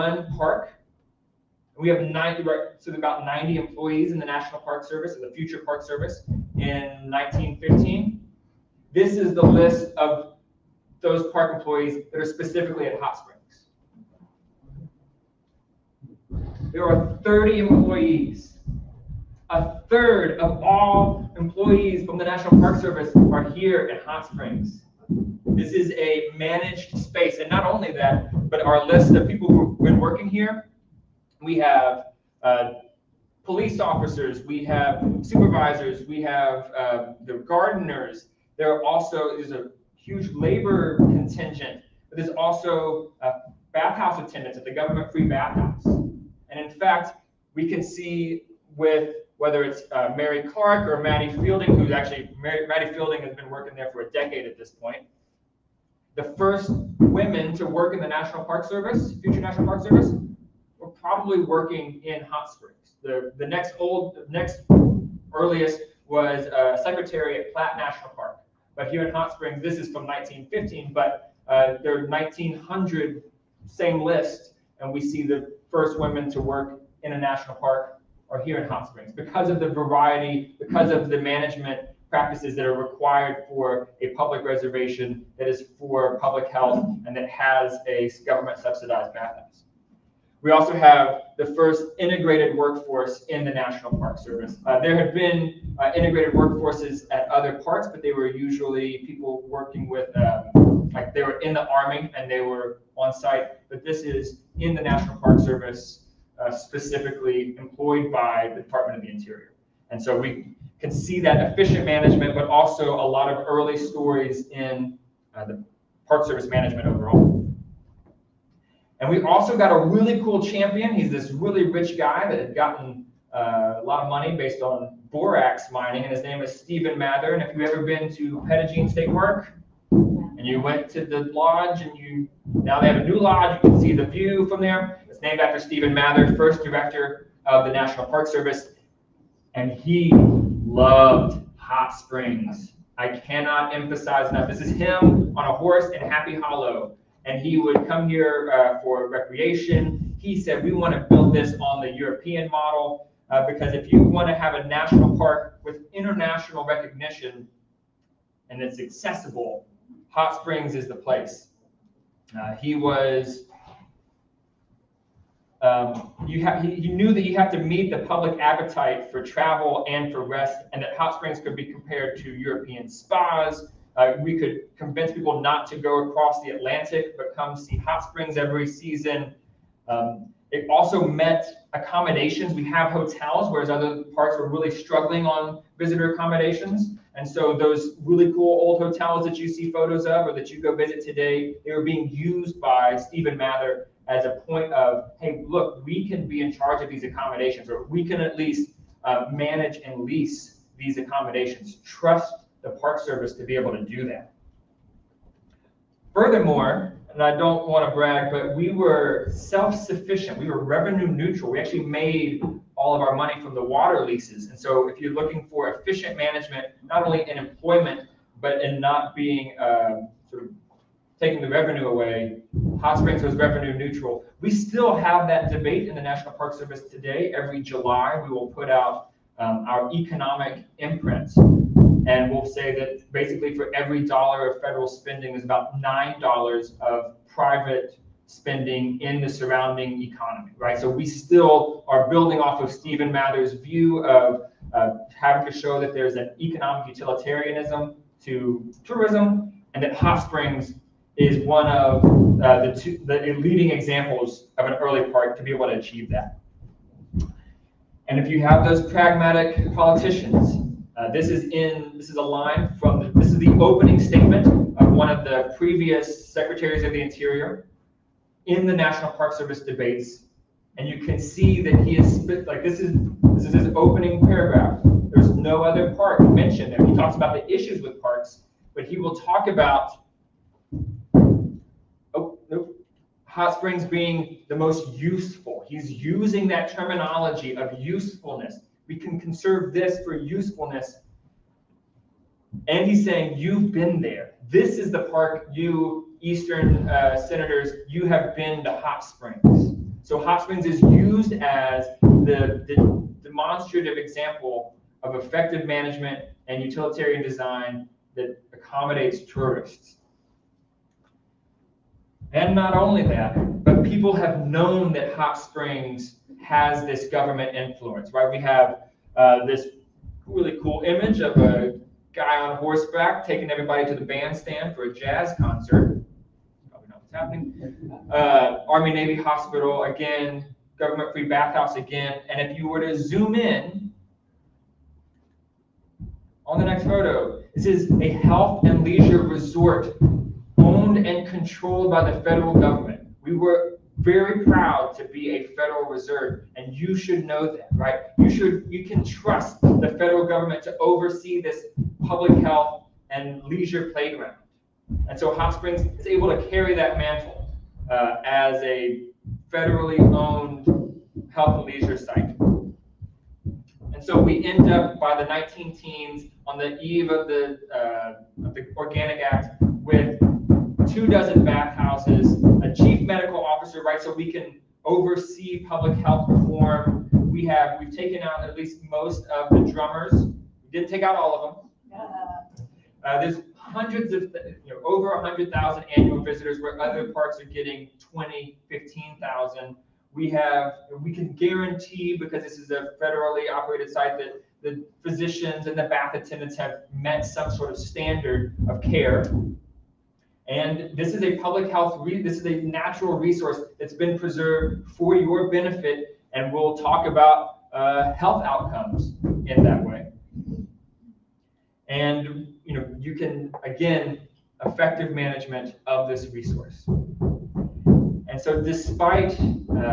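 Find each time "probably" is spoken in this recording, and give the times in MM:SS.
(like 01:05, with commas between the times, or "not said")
01:00, 05:26.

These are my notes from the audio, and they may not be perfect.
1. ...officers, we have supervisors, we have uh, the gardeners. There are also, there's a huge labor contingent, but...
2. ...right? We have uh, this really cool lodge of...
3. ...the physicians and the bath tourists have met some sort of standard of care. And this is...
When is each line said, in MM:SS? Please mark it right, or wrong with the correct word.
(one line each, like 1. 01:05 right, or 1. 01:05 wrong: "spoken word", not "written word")
1. 00:33 right
2. 05:18 wrong: "image", not "lodge"
3. 06:34 wrong: "attendants", not "tourists".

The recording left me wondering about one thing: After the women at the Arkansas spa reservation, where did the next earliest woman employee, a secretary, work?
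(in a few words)
Platt National Park.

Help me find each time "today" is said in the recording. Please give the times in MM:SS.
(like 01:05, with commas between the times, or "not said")
03:11, 03:46.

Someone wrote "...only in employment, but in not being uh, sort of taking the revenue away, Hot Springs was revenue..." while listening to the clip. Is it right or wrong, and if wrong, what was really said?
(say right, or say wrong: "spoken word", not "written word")
right.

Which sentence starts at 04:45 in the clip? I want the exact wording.
He's using that terminology of usefulness.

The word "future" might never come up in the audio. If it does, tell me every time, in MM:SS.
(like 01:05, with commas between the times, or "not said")
00:05, 00:59.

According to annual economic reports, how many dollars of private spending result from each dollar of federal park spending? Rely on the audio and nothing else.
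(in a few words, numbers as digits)
9.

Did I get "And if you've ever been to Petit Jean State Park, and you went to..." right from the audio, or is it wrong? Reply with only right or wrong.
right.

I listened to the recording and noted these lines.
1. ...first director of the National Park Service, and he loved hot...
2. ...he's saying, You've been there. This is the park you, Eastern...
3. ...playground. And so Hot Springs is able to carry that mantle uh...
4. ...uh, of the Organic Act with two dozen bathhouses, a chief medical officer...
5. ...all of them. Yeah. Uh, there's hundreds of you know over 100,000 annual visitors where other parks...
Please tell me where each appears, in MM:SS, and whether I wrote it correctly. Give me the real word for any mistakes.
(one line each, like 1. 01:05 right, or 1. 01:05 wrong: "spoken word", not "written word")
1. 02:16 right
2. 04:52 right
3. 05:53 right
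4. 06:07 right
5. 06:21 right.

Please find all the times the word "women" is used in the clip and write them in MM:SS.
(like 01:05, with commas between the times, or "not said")
00:56, 01:15.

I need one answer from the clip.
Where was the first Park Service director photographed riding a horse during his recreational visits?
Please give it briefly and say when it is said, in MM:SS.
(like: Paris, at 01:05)
Happy Hollow, at 02:26.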